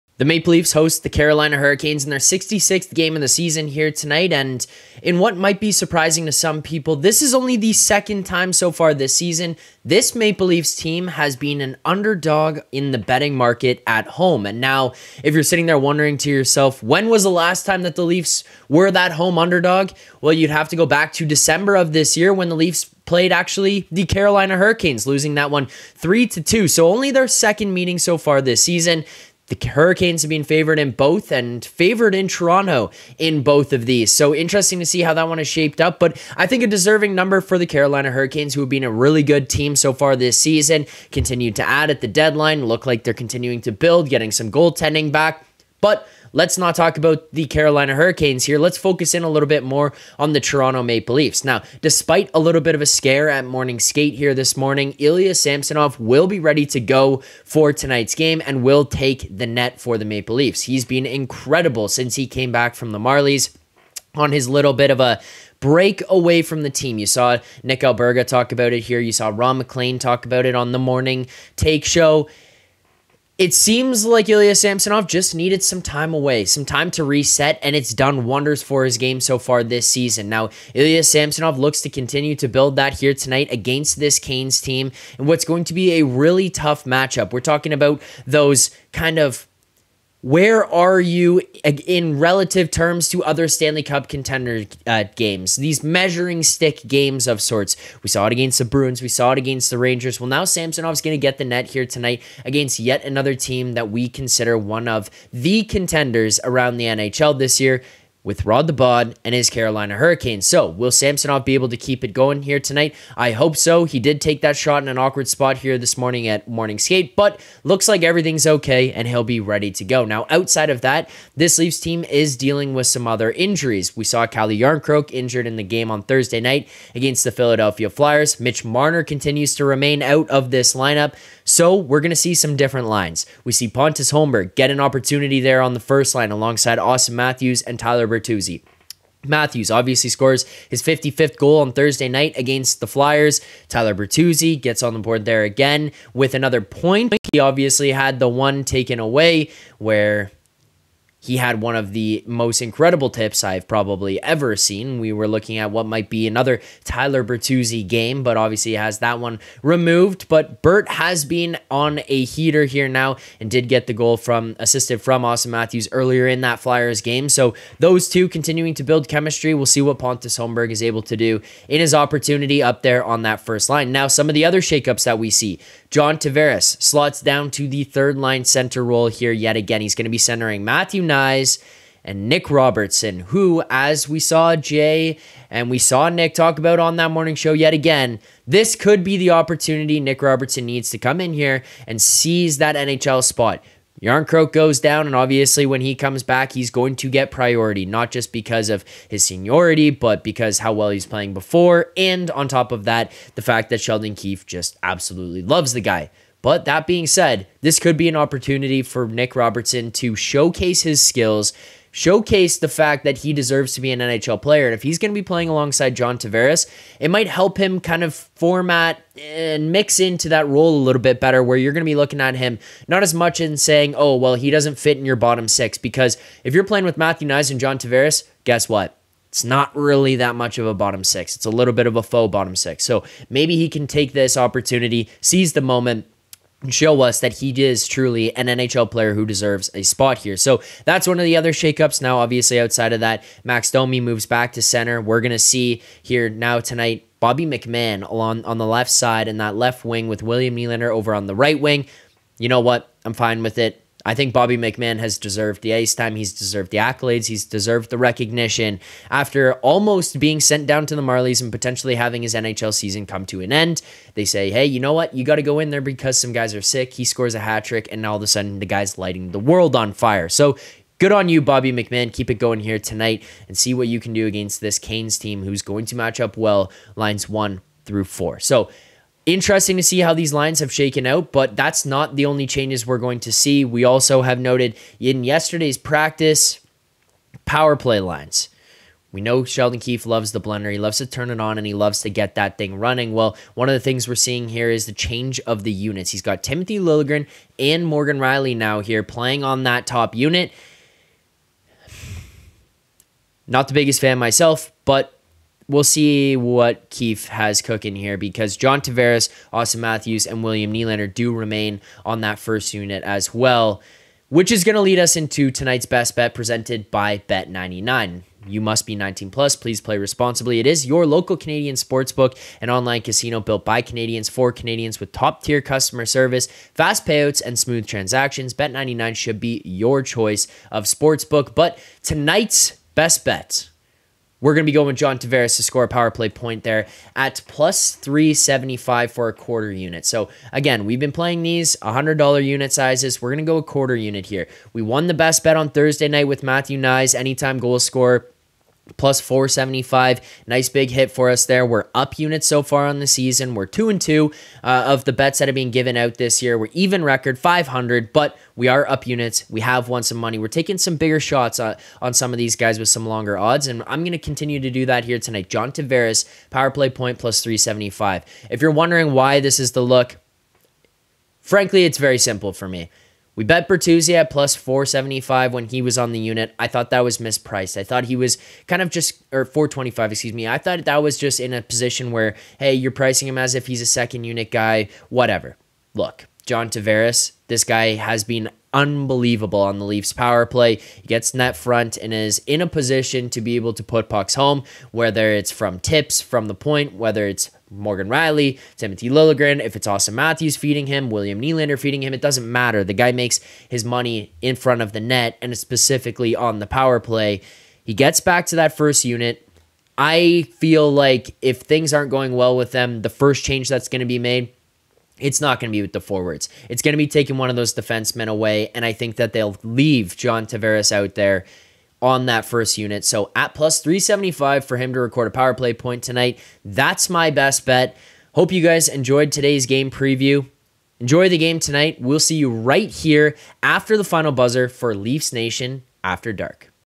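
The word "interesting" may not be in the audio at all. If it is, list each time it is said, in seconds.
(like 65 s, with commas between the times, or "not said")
34 s, 279 s.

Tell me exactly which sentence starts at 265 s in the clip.
You got to go in there because some guys are sick.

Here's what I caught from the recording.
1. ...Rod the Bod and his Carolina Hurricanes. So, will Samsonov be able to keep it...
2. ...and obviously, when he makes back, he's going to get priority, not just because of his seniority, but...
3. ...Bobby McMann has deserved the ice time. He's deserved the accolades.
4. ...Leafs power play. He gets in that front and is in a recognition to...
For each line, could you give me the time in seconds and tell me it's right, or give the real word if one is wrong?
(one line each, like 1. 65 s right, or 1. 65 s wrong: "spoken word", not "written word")
1. 108 s right
2. 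195 s wrong: "comes", not "makes"
3. 254 s right
4. 389 s wrong: "position", not "recognition".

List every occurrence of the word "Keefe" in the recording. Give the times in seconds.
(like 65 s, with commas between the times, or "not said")
204 s, 289 s, 306 s.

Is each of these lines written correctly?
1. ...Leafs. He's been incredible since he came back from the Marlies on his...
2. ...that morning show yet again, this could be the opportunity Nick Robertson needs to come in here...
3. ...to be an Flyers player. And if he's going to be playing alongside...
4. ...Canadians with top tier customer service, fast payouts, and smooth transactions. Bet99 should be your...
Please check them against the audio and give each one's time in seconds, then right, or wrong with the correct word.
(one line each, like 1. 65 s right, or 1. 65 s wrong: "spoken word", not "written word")
1. 60 s right
2. 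186 s right
3. 213 s wrong: "NHL", not "Flyers"
4. 324 s right.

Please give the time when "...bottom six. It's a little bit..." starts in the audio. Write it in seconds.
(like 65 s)
230 s.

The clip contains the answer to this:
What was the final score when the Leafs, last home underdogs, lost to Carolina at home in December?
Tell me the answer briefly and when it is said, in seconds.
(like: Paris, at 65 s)
3 to 2, at 25 s.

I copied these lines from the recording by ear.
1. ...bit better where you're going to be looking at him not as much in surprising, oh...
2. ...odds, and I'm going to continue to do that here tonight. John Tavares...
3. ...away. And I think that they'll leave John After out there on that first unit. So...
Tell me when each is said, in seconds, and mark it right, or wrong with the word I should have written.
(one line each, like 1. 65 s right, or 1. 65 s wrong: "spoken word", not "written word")
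1. 221 s wrong: "saying", not "surprising"
2. 363 s right
3. 418 s wrong: "Tavares", not "After".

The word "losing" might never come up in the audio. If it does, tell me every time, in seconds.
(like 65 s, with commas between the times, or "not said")
25 s.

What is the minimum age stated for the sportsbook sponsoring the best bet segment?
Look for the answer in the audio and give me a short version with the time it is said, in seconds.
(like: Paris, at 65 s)
19+, at 318 s.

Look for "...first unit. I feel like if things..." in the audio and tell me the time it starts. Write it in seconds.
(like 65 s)
408 s.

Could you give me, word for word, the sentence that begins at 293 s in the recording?
Well, one of the things we're seeing here is the change of the units.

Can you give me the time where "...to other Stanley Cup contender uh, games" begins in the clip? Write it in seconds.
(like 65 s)
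93 s.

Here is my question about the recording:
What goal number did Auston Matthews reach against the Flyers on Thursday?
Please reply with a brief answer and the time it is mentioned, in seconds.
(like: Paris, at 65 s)
55th, at 140 s.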